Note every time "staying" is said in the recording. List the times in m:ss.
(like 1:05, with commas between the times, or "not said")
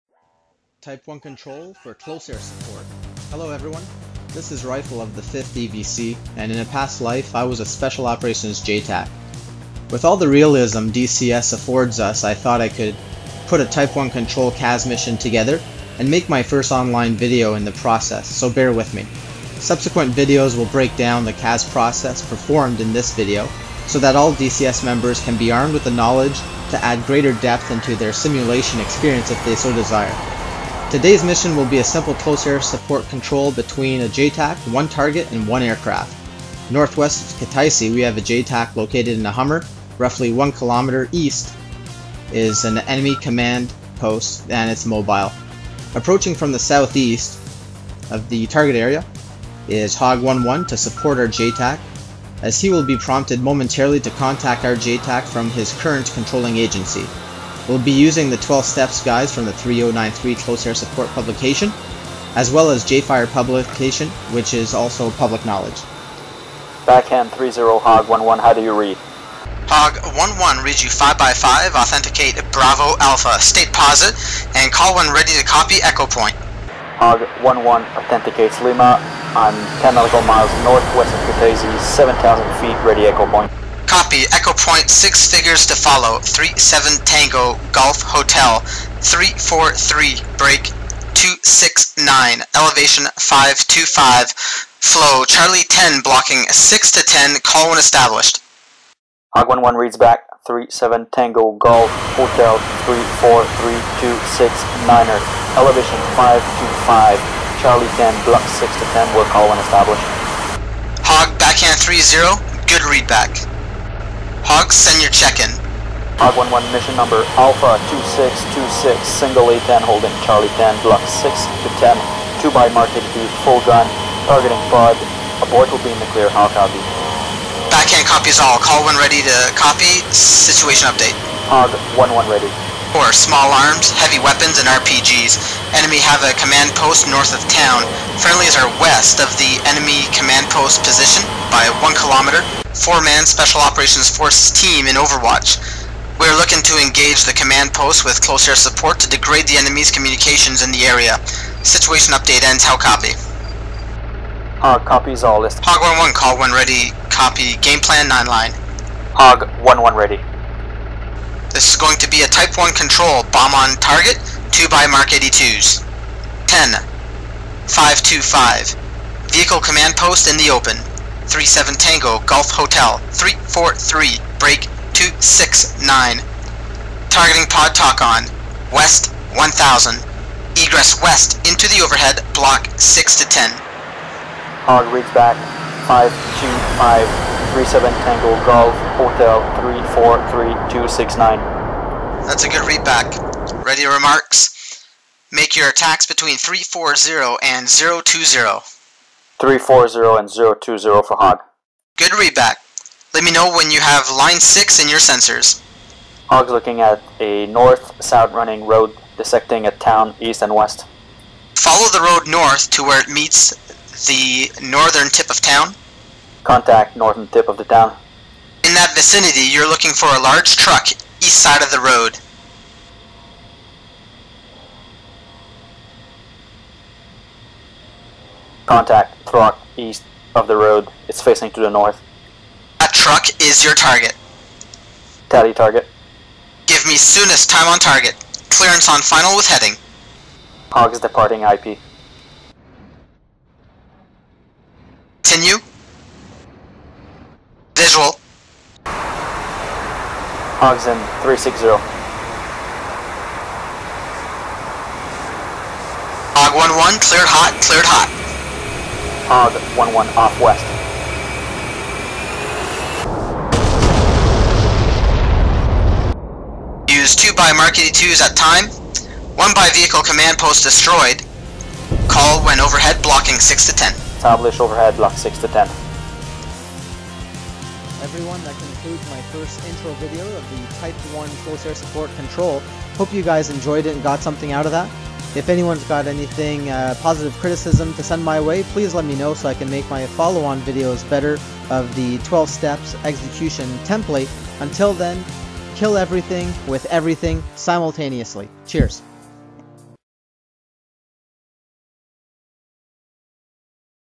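not said.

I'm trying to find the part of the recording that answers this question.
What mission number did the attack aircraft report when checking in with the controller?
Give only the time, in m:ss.
1:57.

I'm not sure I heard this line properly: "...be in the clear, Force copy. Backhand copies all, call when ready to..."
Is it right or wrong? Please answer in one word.
wrong.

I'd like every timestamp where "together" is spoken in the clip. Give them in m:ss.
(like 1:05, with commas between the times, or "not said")
0:15.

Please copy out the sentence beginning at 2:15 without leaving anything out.
Enemy have a command post north of town.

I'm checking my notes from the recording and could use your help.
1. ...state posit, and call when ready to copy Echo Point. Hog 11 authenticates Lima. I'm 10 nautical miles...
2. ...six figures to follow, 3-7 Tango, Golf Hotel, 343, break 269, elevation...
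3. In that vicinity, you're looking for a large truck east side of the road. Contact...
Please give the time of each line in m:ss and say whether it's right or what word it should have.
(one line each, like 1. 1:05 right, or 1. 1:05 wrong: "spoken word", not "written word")
1. 1:13 right
2. 1:24 right
3. 3:38 right.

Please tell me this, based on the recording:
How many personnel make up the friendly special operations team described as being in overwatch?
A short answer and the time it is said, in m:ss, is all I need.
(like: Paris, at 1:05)
4, at 2:22.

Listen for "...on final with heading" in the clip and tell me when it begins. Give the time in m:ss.
3:58.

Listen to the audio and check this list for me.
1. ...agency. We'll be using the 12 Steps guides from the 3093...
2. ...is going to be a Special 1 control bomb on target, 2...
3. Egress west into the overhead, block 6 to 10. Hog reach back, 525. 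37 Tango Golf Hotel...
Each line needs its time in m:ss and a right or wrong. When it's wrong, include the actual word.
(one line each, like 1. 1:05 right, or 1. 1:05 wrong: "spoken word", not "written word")
1. 0:56 right
2. 2:41 wrong: "Type", not "Special"
3. 3:00 right.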